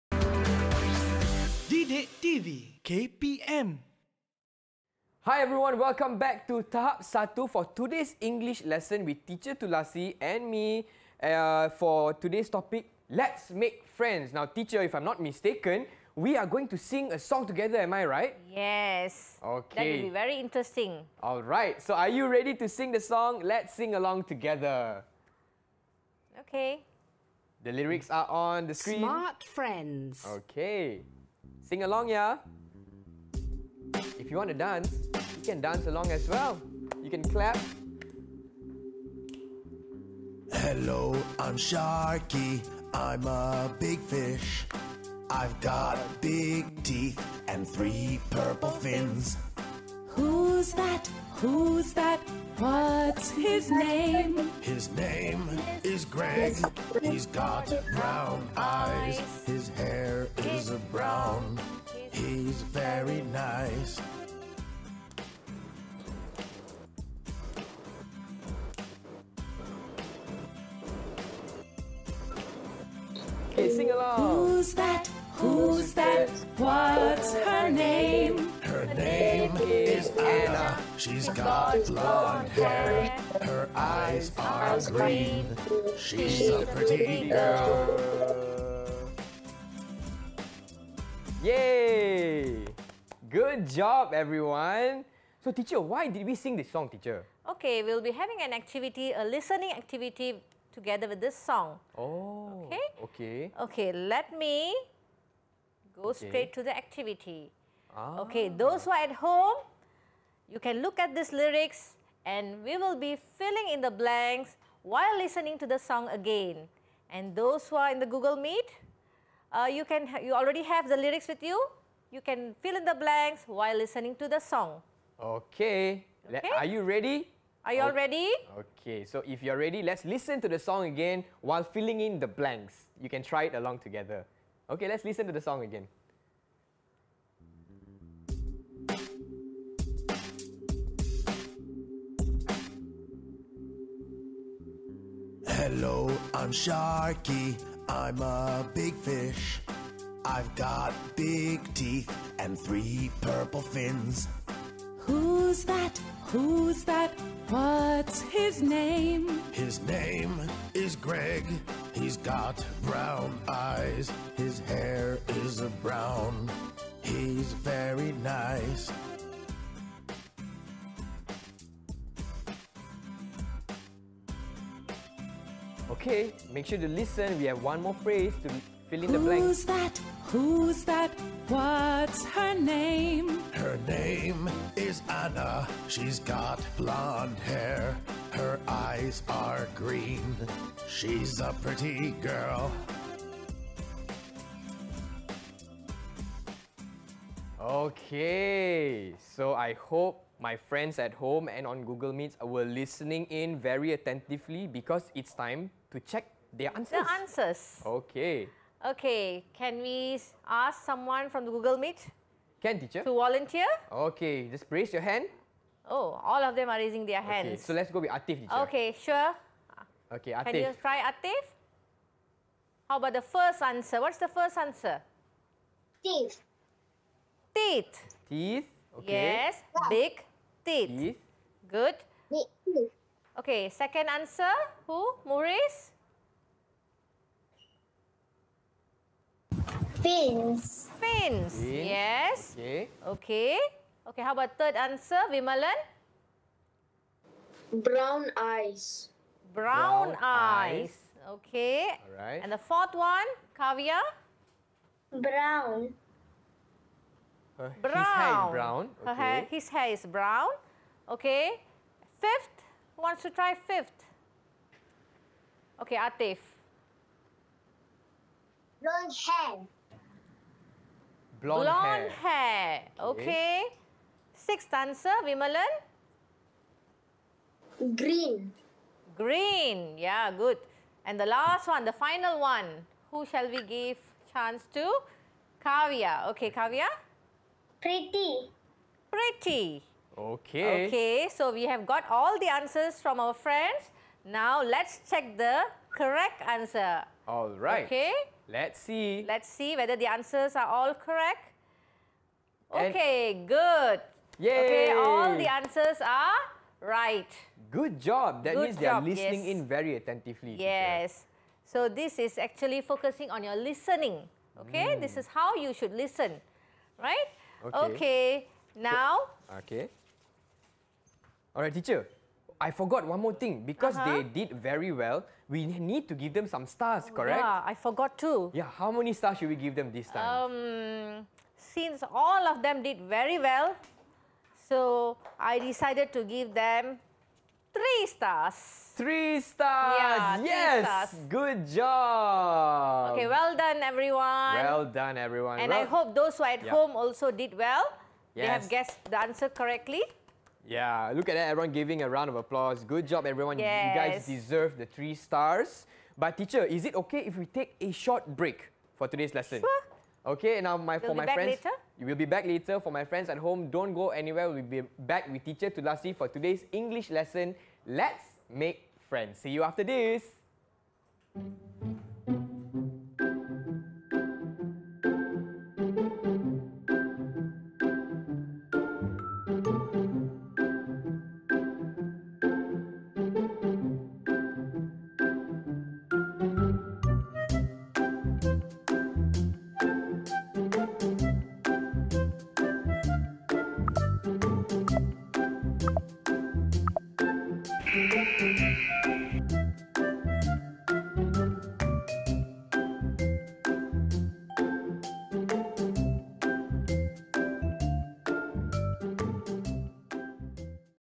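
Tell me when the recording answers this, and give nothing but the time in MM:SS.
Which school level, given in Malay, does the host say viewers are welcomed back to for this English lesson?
00:06.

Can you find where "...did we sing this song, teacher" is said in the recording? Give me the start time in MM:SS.
01:36.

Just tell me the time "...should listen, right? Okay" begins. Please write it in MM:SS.
05:15.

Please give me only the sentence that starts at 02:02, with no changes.
You can fill in the blanks while listening to the song.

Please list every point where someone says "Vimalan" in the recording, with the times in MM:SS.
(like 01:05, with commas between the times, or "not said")
04:05, 04:35.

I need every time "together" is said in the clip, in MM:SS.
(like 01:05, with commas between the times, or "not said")
00:17, 00:24, 01:40, 02:13.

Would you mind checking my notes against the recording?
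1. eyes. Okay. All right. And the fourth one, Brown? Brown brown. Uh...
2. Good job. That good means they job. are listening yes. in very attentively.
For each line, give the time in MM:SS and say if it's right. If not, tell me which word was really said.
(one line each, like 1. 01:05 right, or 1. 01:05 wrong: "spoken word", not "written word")
1. 04:10 wrong: "Kavya", not "Brown"
2. 05:07 right.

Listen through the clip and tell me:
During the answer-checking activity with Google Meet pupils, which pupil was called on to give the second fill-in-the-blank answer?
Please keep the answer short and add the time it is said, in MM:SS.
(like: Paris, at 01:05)
Maurice, at 03:55.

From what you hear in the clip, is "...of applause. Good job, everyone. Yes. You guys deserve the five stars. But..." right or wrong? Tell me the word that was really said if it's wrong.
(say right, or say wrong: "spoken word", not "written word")
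wrong: "three", not "five".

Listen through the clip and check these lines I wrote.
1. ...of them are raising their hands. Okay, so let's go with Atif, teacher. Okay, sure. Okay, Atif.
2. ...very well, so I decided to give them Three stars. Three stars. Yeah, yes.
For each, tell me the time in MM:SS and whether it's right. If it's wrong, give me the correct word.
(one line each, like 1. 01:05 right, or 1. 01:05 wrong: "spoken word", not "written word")
1. 03:36 right
2. 05:33 right.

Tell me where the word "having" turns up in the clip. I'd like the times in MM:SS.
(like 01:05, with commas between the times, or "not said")
01:38.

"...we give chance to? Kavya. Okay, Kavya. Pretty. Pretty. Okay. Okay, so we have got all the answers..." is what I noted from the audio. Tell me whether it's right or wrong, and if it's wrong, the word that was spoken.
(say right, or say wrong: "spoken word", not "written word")
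right.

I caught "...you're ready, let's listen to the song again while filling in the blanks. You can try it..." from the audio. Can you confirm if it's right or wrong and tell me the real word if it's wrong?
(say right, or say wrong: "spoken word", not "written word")
right.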